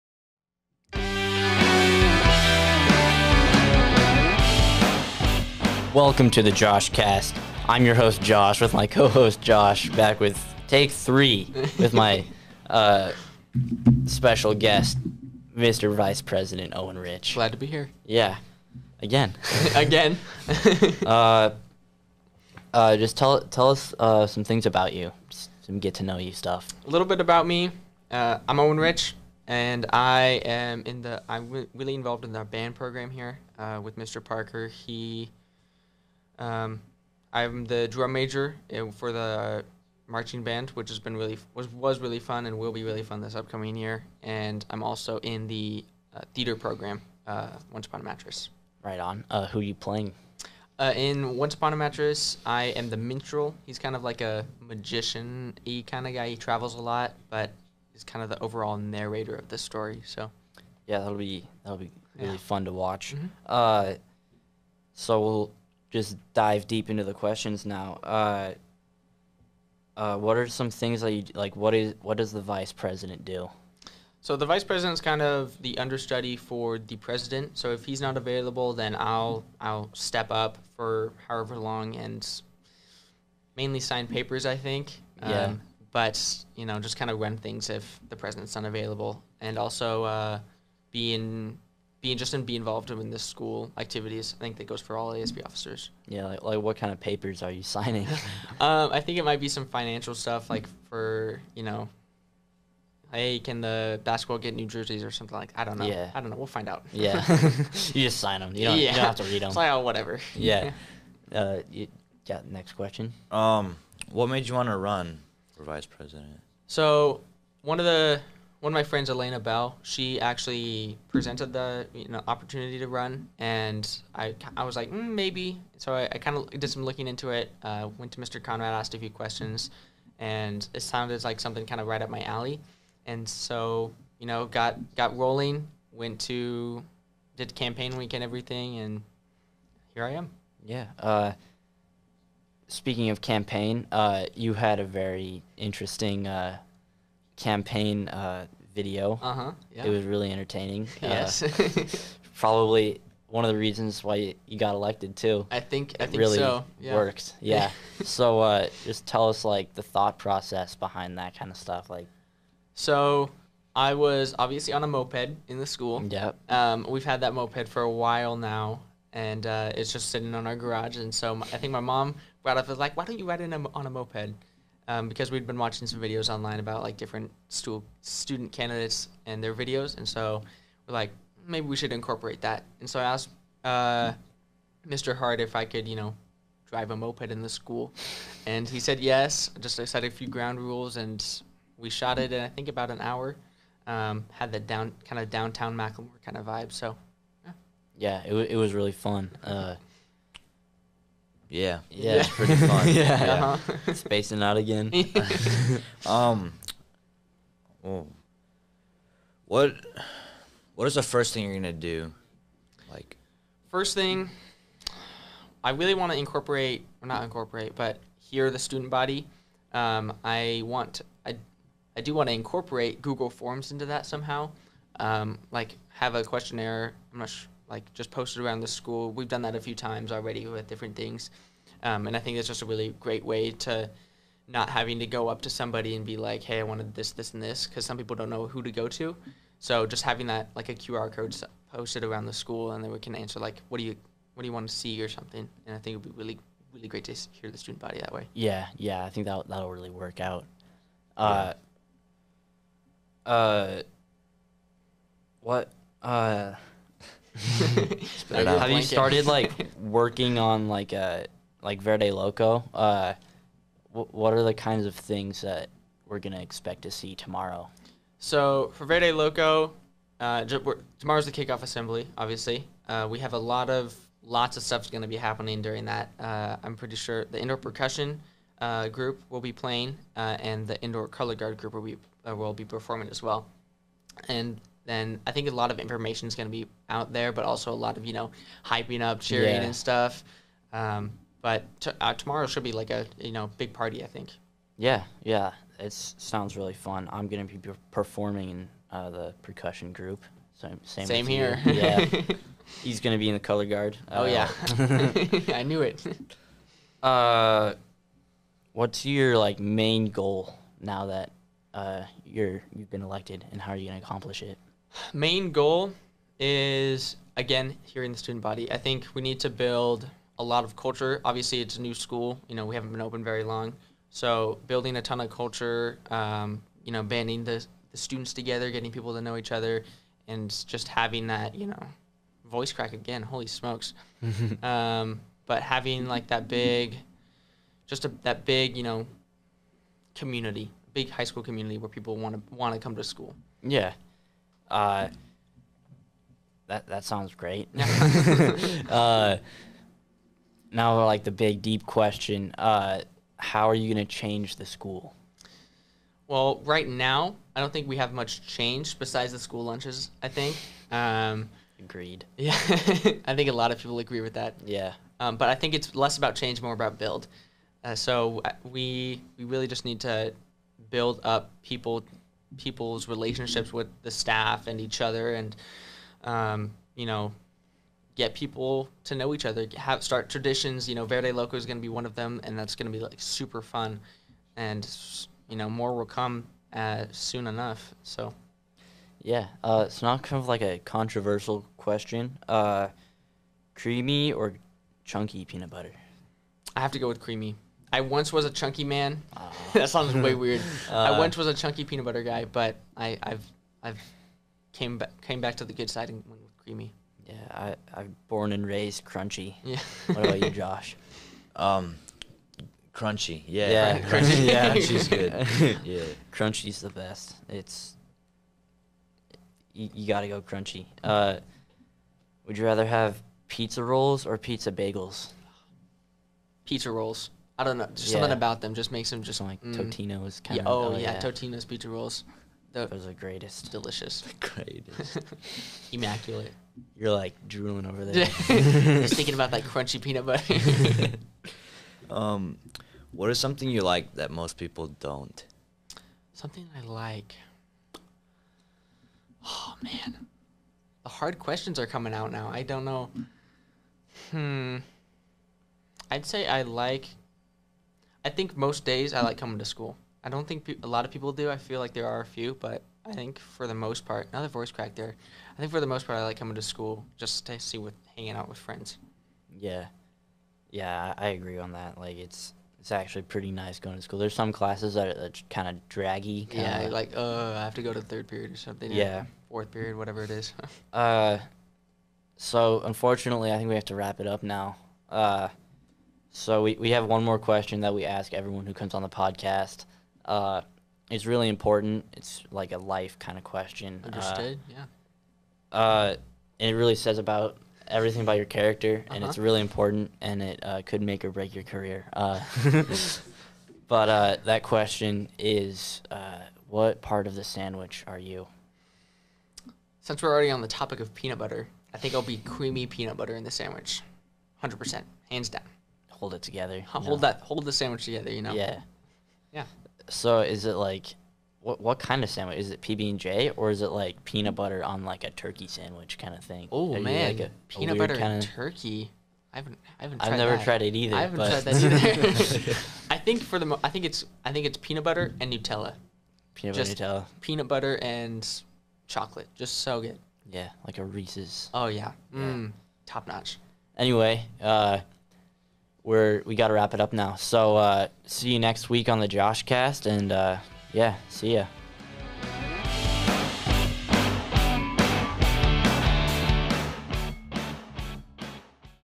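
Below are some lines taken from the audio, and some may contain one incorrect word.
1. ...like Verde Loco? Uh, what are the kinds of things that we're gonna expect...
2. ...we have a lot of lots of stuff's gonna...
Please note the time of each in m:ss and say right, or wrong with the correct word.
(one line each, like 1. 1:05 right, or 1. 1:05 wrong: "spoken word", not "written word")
1. 4:21 right
2. 4:33 right.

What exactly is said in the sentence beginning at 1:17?
So if he's not available, then I'll I'll step up for however long and mainly sign papers.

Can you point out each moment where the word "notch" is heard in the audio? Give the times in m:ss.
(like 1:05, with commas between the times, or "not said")
9:03.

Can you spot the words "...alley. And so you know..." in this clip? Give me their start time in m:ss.
2:12.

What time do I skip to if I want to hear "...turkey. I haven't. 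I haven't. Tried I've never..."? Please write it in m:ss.
8:48.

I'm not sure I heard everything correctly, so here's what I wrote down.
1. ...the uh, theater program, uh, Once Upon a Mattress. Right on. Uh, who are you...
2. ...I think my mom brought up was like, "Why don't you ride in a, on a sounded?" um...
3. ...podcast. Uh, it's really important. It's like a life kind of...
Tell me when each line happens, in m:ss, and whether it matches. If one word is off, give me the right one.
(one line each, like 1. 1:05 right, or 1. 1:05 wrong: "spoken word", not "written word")
1. 0:45 right
2. 2:51 wrong: "moped", not "sounded"
3. 8:09 right.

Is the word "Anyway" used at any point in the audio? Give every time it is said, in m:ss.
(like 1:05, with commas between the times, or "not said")
9:03.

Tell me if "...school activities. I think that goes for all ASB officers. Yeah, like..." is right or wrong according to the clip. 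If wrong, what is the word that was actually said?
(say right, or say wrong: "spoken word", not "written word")
right.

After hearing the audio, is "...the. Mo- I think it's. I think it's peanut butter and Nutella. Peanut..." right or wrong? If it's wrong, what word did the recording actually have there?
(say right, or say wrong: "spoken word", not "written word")
right.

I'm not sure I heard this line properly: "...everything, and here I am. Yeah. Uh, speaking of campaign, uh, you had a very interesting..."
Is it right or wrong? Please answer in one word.
right.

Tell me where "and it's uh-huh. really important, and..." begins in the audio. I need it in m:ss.
8:19.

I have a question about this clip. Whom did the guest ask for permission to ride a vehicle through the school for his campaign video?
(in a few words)
Mr. Hart.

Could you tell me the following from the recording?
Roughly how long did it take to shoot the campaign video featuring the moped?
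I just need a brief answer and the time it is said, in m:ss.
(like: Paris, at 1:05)
about an hour, at 3:12.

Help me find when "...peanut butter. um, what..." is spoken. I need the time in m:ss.
7:20.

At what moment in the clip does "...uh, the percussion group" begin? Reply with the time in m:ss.
4:58.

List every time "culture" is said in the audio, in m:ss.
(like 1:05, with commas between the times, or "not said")
5:20, 5:25.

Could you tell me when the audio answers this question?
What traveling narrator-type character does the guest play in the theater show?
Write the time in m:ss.
0:52.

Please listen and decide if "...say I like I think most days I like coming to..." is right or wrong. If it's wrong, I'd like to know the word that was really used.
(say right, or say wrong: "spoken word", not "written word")
right.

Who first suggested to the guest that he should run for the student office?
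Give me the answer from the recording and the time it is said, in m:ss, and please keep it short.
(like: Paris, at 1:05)
Elena Bell, at 1:59.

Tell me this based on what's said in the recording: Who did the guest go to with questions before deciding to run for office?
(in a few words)
Mr. Conrad.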